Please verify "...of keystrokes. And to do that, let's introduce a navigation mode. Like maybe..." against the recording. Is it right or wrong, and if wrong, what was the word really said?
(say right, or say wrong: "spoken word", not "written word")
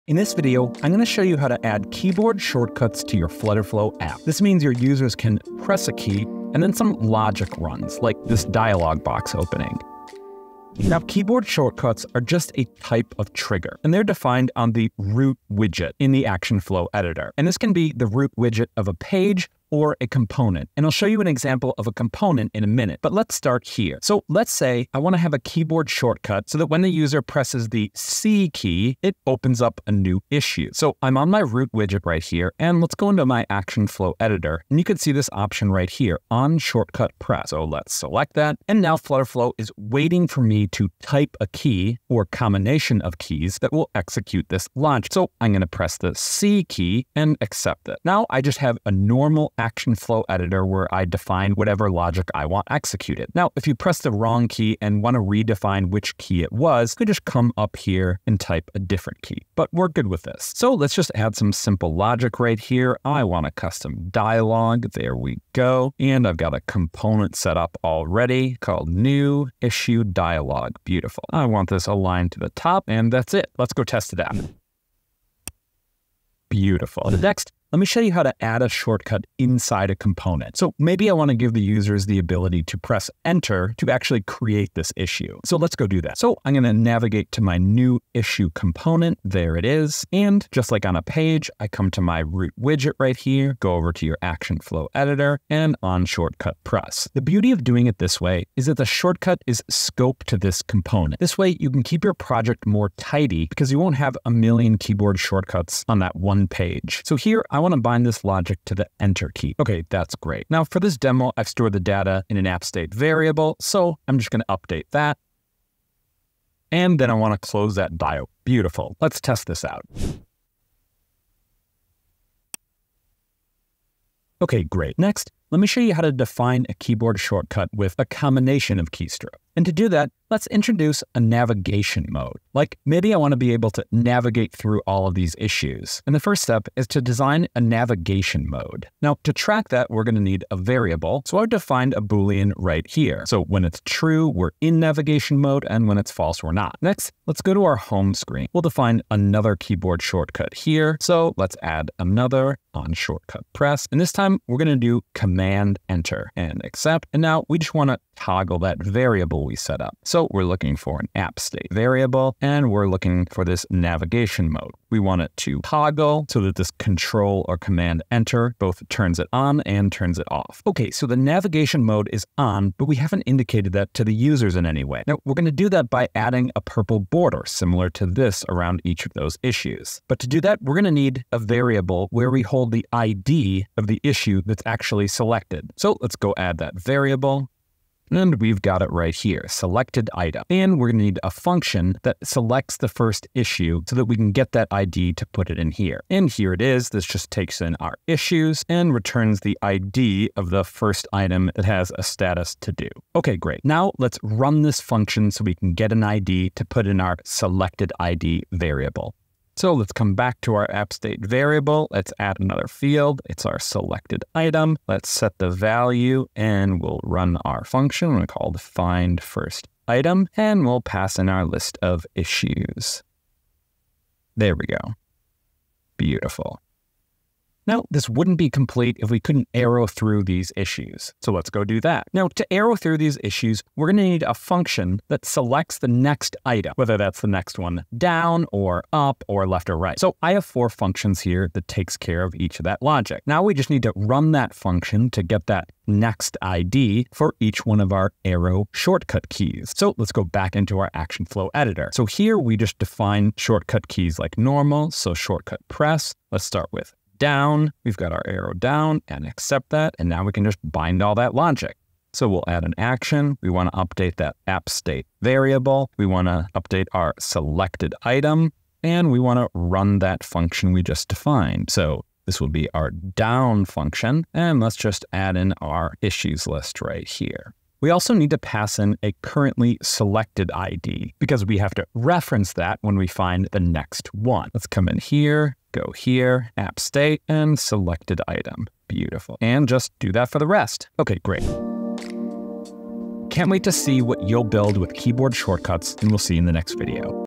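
right.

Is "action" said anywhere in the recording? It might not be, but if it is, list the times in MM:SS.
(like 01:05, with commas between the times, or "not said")
00:16, 00:33, 00:49, 01:34, 04:10, 04:22.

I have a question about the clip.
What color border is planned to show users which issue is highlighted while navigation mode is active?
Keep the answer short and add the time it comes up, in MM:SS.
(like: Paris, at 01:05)
Purple, at 02:56.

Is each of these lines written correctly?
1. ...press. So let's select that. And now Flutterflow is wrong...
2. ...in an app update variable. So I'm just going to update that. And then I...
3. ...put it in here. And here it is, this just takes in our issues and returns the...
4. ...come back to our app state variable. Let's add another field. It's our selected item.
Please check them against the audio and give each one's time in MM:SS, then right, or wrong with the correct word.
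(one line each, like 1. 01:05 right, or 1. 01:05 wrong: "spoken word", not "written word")
1. 00:37 wrong: "waiting", not "wrong"
2. 01:52 wrong: "state", not "update"
3. 03:15 right
4. 03:29 right.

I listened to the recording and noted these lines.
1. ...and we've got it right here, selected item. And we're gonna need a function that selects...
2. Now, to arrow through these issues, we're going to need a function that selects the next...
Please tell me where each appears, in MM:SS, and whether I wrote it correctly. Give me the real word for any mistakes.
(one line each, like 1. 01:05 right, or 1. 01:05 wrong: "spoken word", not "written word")
1. 03:08 right
2. 03:52 right.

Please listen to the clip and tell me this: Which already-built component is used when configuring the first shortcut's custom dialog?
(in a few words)
New issue dialogue.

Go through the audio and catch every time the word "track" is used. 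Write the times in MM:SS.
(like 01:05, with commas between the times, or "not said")
02:19.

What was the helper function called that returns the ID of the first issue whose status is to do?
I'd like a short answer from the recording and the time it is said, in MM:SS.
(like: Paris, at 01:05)
Find first item, at 03:38.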